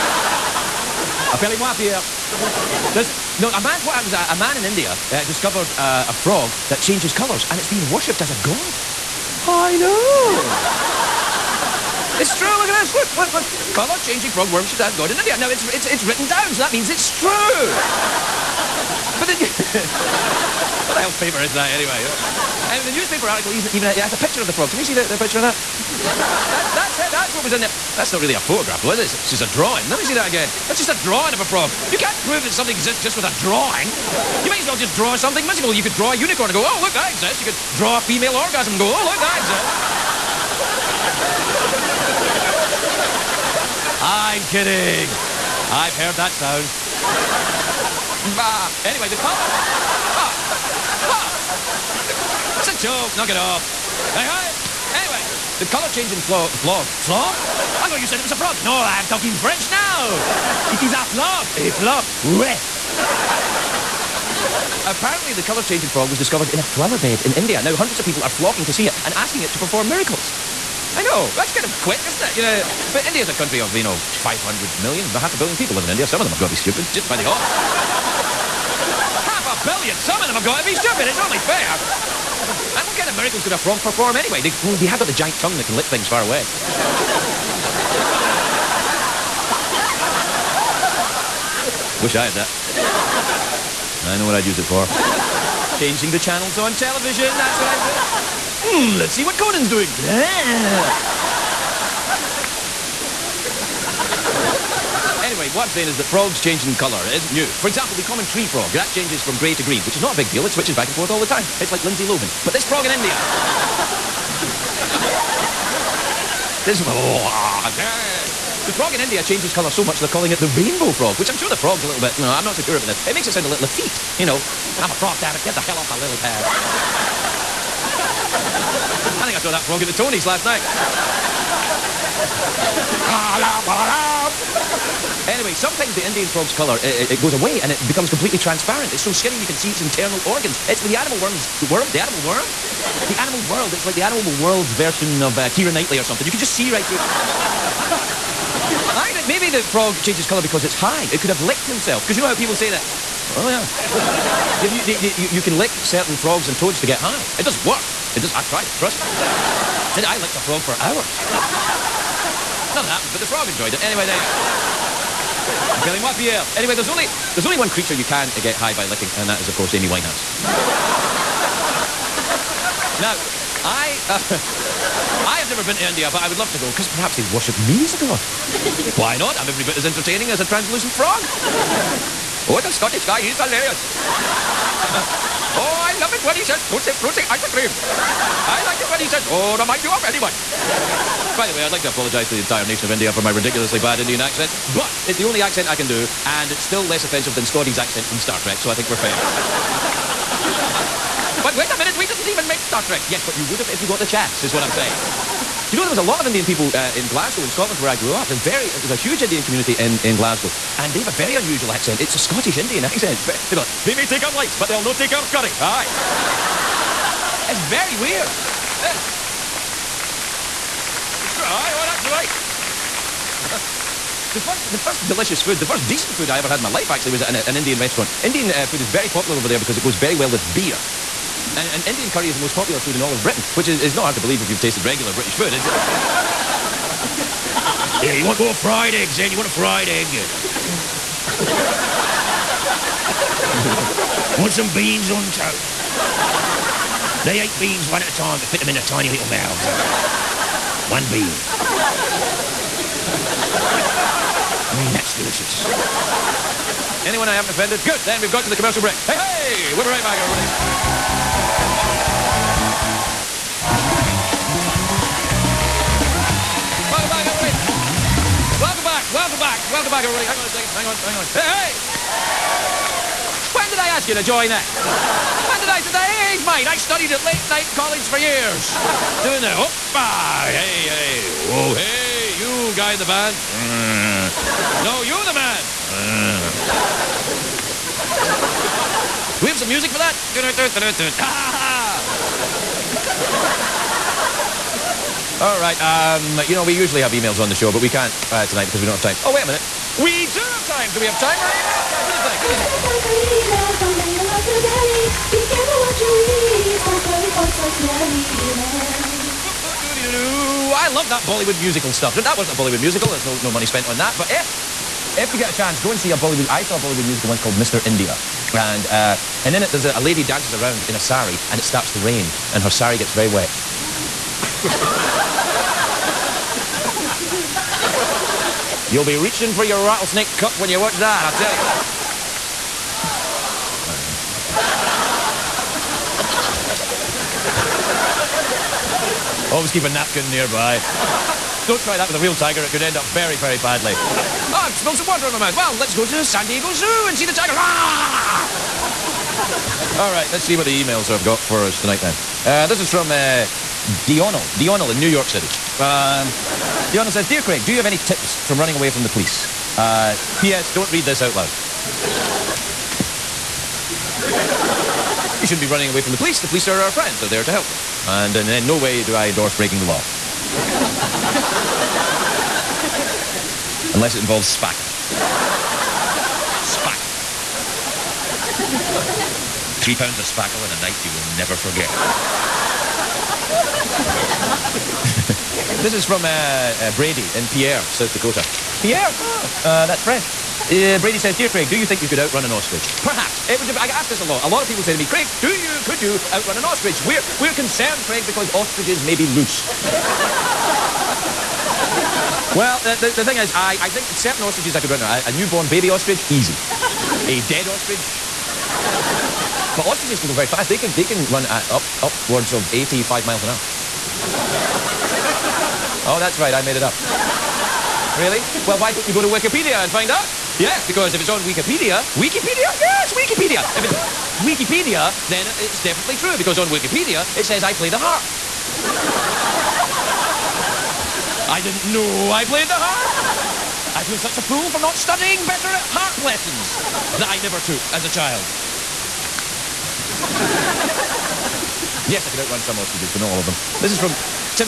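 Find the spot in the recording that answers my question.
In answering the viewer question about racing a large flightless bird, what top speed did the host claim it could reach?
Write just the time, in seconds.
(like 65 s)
412 s.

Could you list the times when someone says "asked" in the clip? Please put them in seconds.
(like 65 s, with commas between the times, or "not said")
393 s.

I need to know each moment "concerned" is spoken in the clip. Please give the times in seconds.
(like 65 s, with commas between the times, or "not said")
397 s.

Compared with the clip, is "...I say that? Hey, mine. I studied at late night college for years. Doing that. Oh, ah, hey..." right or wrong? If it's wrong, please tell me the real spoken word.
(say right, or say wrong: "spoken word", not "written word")
right.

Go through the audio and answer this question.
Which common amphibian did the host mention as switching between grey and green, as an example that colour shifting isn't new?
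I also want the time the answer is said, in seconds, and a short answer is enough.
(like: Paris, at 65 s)
common tree frog, at 108 s.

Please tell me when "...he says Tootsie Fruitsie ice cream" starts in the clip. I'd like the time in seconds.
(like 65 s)
186 s.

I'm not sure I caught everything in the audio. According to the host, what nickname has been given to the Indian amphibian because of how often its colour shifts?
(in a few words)
rainbow frog.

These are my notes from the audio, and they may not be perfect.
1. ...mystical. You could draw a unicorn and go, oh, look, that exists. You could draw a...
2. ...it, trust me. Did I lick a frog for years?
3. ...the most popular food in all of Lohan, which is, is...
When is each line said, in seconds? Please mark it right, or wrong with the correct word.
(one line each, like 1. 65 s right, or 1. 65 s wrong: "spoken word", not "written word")
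1. 35 s right
2. 158 s wrong: "hours", not "years"
3. 232 s wrong: "Britain", not "Lohan".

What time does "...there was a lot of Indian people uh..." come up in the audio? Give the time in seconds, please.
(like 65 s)
205 s.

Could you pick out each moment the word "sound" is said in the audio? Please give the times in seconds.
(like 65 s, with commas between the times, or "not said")
46 s, 123 s.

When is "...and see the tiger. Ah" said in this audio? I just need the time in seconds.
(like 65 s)
347 s.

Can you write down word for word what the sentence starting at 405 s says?
A, a newborn baby ostrich, easy.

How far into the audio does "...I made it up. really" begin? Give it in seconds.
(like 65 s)
416 s.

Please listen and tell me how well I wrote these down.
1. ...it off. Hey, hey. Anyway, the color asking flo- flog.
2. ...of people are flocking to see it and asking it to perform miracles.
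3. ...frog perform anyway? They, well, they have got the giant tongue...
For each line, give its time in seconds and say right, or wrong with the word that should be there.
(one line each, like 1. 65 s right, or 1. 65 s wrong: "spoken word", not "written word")
1. 53 s wrong: "changing", not "asking"
2. 67 s right
3. 83 s right.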